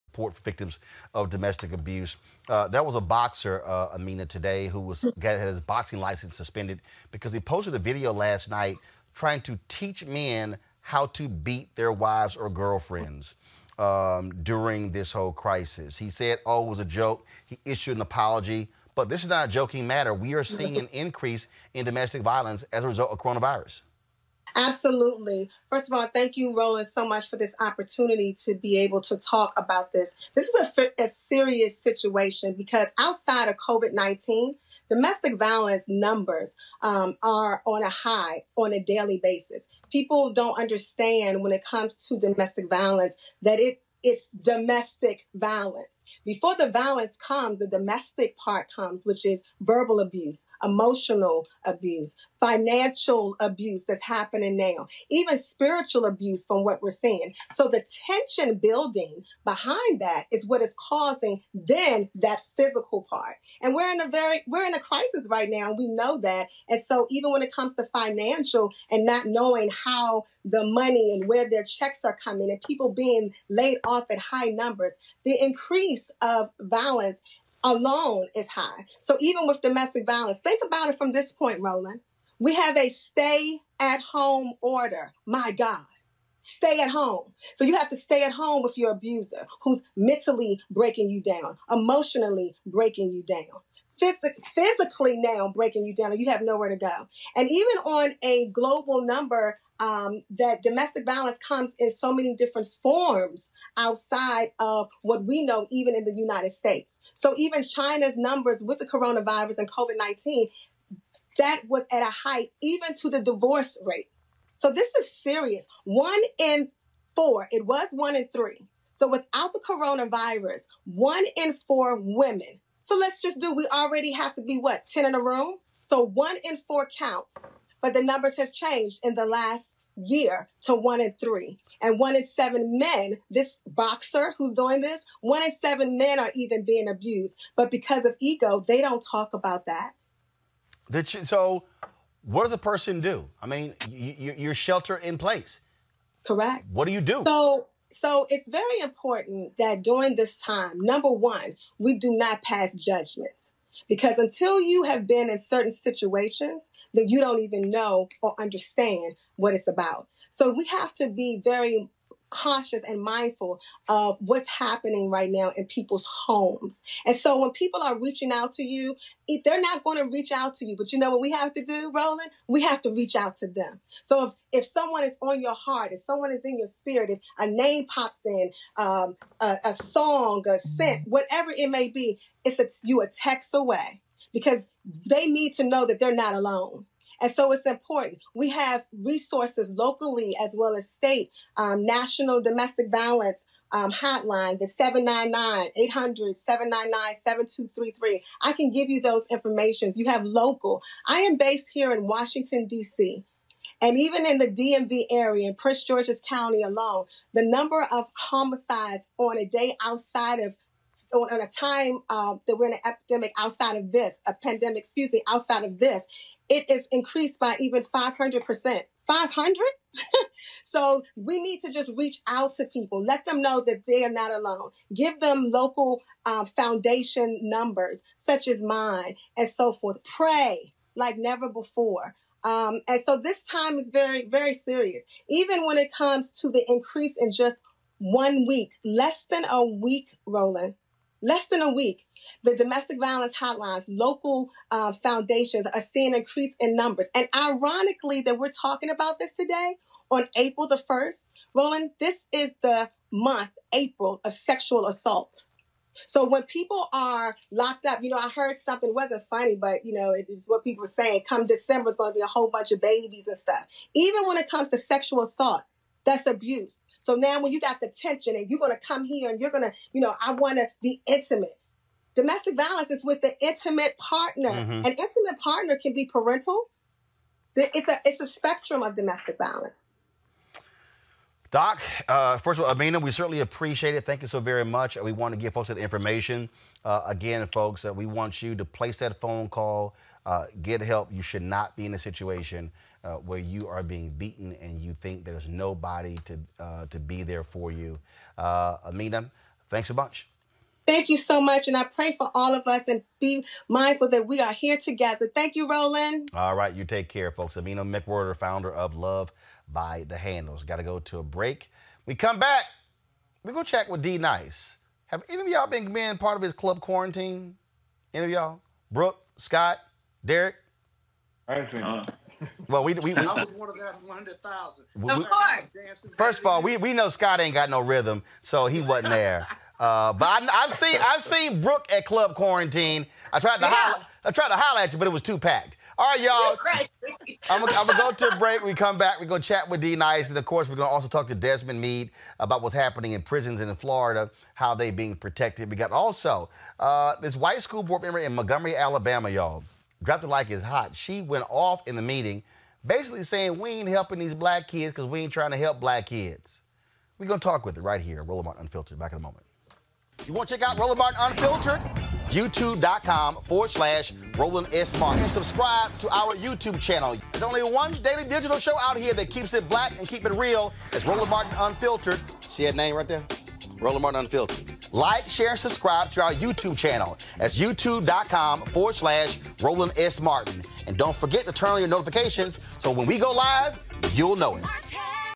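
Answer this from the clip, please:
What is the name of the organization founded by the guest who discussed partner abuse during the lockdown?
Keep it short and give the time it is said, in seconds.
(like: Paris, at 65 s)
Love by the Handles, at 308 s.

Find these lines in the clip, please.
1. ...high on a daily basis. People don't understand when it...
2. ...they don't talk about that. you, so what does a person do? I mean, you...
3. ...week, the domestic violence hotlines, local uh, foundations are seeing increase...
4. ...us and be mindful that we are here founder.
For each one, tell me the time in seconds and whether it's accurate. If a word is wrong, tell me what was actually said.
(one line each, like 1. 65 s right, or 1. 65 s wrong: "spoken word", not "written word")
1. 37 s right
2. 138 s right
3. 241 s right
4. 302 s wrong: "together", not "founder".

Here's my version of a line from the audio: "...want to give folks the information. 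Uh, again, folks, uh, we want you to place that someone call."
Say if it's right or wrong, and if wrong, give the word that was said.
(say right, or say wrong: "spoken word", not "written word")
wrong: "phone", not "someone".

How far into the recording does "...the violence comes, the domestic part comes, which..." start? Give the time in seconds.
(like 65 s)
46 s.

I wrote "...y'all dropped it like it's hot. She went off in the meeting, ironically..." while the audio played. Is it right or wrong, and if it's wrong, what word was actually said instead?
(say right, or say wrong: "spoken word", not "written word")
wrong: "basically", not "ironically".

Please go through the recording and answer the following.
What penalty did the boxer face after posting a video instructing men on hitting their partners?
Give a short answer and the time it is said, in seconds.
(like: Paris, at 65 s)
Boxing license suspended, at 5 s.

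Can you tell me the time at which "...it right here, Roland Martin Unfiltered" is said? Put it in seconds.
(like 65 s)
357 s.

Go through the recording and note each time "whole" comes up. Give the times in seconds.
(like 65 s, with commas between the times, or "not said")
15 s, 262 s.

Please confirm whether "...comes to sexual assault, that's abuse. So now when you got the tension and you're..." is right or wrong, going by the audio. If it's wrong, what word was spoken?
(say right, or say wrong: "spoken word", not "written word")
right.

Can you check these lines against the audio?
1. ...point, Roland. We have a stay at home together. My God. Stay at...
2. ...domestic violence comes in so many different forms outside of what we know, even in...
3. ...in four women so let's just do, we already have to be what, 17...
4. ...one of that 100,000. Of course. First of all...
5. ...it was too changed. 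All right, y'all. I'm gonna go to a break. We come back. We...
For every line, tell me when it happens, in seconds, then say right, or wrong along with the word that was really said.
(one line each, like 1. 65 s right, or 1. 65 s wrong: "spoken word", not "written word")
1. 81 s wrong: "order", not "together"
2. 100 s right
3. 121 s wrong: "10", not "17"
4. 323 s right
5. 335 s wrong: "packed", not "changed".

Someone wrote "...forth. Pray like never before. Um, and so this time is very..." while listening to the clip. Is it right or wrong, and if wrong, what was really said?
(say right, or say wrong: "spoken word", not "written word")
right.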